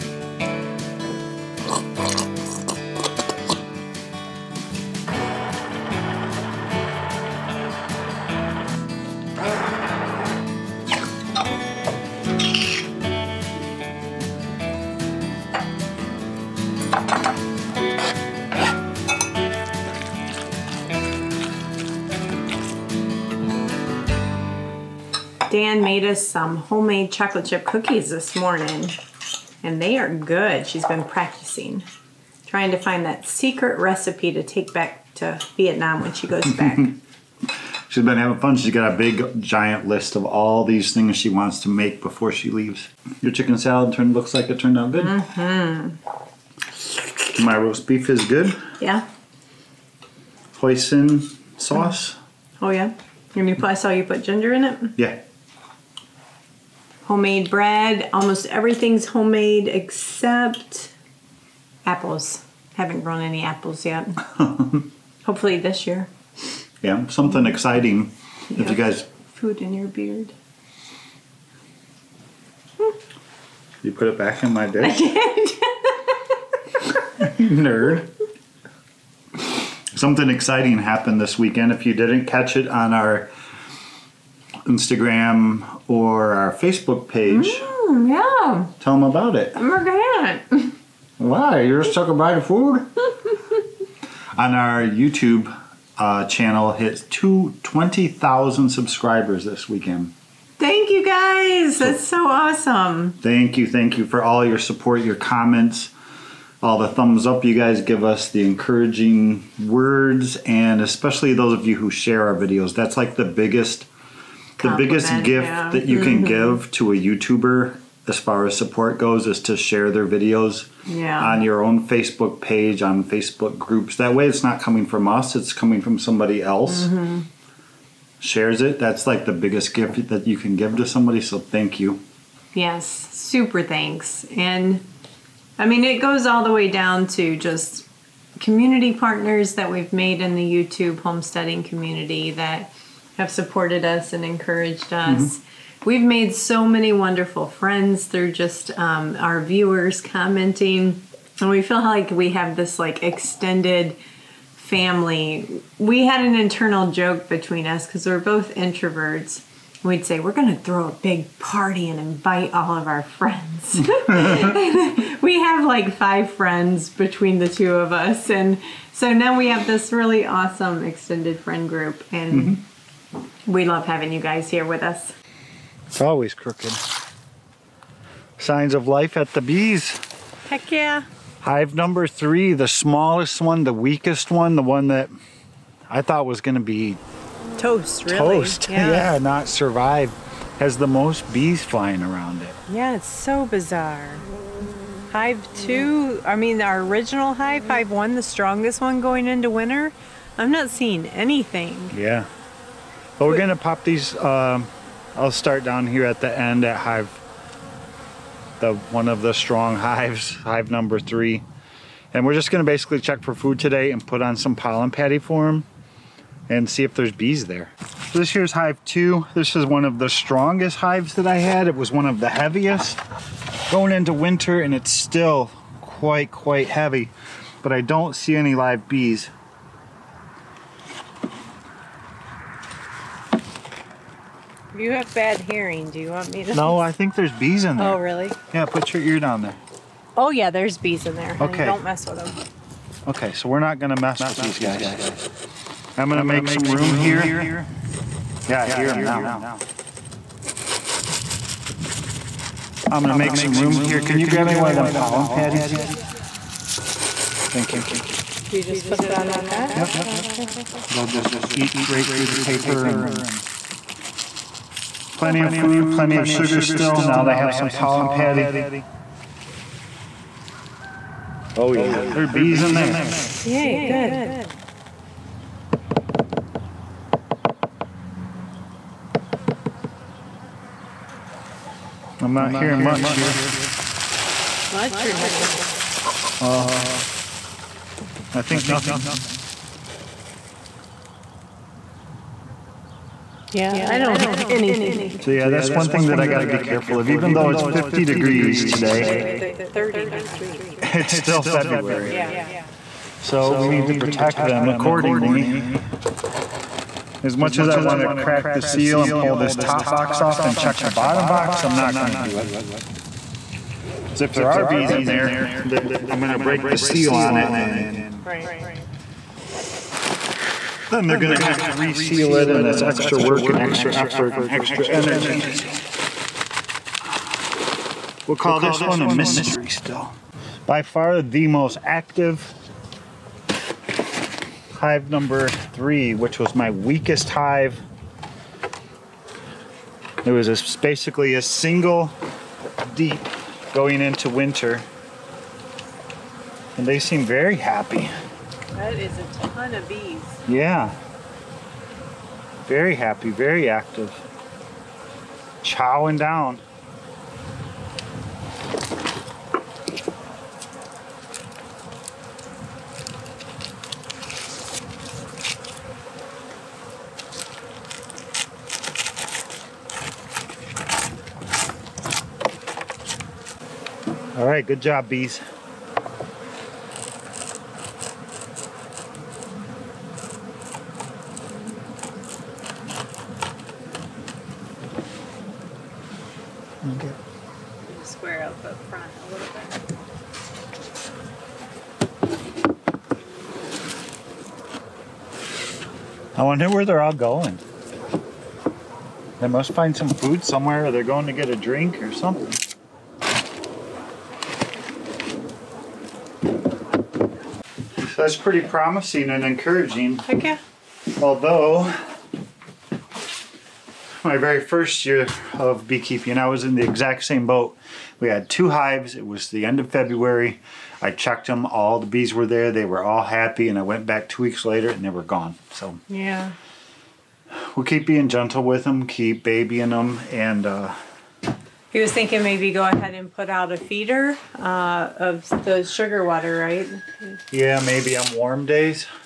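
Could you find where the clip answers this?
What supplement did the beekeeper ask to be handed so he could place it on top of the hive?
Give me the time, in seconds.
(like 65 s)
254 s.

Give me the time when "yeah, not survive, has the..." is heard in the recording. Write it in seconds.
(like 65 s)
189 s.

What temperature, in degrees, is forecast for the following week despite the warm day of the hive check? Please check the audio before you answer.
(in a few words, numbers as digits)
30.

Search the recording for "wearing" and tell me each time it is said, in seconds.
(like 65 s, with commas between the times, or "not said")
not said.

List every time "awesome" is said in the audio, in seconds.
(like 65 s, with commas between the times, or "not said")
102 s, 170 s.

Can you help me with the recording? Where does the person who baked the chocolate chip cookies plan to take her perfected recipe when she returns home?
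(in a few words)
Vietnam.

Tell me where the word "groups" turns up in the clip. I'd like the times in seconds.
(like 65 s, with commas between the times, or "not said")
123 s, 171 s.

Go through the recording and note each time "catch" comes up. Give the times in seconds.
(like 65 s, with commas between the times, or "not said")
82 s.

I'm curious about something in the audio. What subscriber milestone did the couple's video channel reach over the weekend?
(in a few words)
20,000.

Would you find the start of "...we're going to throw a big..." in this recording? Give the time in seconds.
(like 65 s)
160 s.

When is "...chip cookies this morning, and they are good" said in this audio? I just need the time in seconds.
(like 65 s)
27 s.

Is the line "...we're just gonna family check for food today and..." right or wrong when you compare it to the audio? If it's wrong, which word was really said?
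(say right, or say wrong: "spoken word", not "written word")
wrong: "basically", not "family".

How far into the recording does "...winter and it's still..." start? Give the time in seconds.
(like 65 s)
224 s.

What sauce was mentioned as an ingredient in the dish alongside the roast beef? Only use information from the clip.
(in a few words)
Hoisin sauce.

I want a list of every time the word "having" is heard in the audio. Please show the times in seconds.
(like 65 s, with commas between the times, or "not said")
38 s, 173 s.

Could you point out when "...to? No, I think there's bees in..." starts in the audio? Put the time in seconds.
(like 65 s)
236 s.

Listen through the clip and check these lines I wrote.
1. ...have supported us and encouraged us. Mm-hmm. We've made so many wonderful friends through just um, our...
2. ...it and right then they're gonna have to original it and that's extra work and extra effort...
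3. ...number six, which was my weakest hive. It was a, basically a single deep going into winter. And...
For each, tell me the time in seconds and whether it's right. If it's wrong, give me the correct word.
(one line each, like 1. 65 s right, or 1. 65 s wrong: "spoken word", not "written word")
1. 143 s right
2. 317 s wrong: "reseal", not "original"
3. 335 s wrong: "three", not "six".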